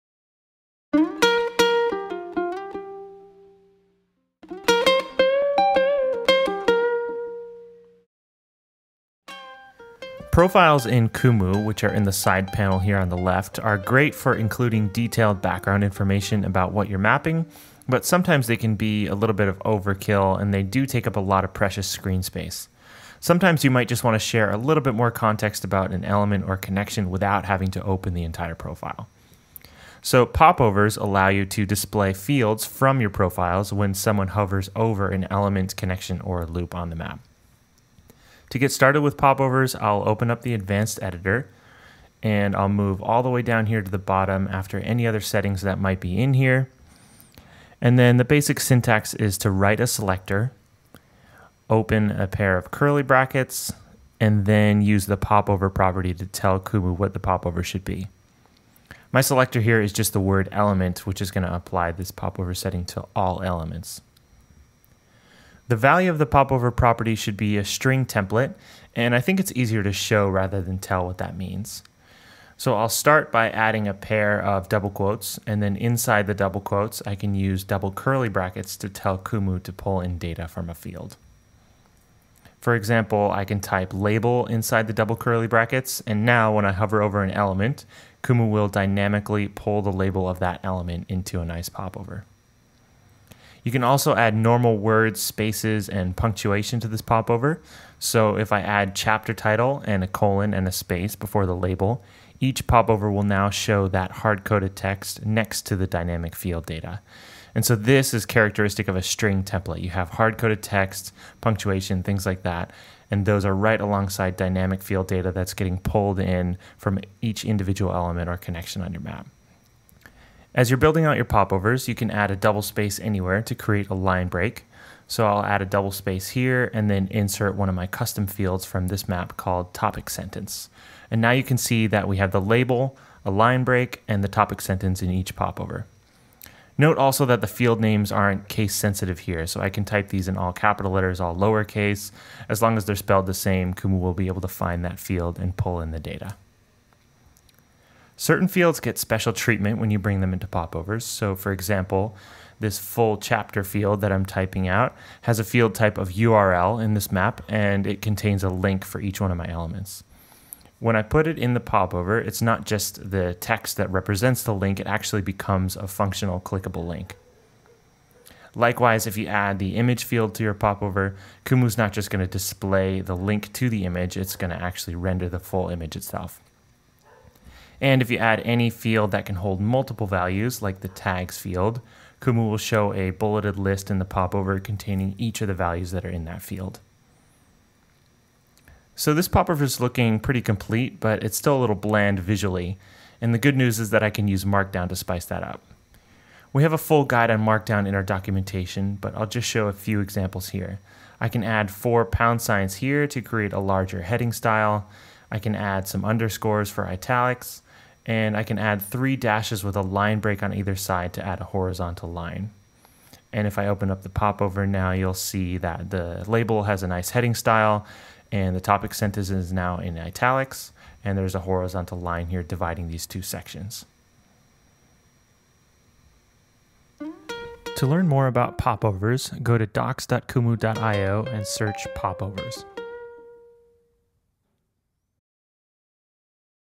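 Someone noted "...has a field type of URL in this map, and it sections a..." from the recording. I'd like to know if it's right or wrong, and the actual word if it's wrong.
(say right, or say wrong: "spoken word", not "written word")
wrong: "contains", not "sections".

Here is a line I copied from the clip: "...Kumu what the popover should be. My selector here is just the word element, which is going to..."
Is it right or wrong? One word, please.
right.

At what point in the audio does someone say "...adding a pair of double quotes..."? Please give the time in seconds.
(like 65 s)
73 s.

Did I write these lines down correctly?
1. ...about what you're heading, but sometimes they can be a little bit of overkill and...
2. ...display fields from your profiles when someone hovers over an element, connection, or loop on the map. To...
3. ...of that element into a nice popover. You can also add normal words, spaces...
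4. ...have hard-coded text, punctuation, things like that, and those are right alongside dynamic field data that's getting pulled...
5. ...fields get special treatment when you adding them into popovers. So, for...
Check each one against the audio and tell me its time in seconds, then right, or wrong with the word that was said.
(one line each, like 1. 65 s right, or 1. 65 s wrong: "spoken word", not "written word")
1. 16 s wrong: "mapping", not "heading"
2. 31 s right
3. 90 s right
4. 109 s right
5. 148 s wrong: "bring", not "adding".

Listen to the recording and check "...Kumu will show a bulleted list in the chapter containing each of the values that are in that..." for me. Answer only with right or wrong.
wrong.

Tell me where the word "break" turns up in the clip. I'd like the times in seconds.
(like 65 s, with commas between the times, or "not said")
124 s, 133 s, 210 s.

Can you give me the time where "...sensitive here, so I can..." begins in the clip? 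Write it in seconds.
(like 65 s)
138 s.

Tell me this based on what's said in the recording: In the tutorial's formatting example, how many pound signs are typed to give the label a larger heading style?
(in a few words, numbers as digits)
4.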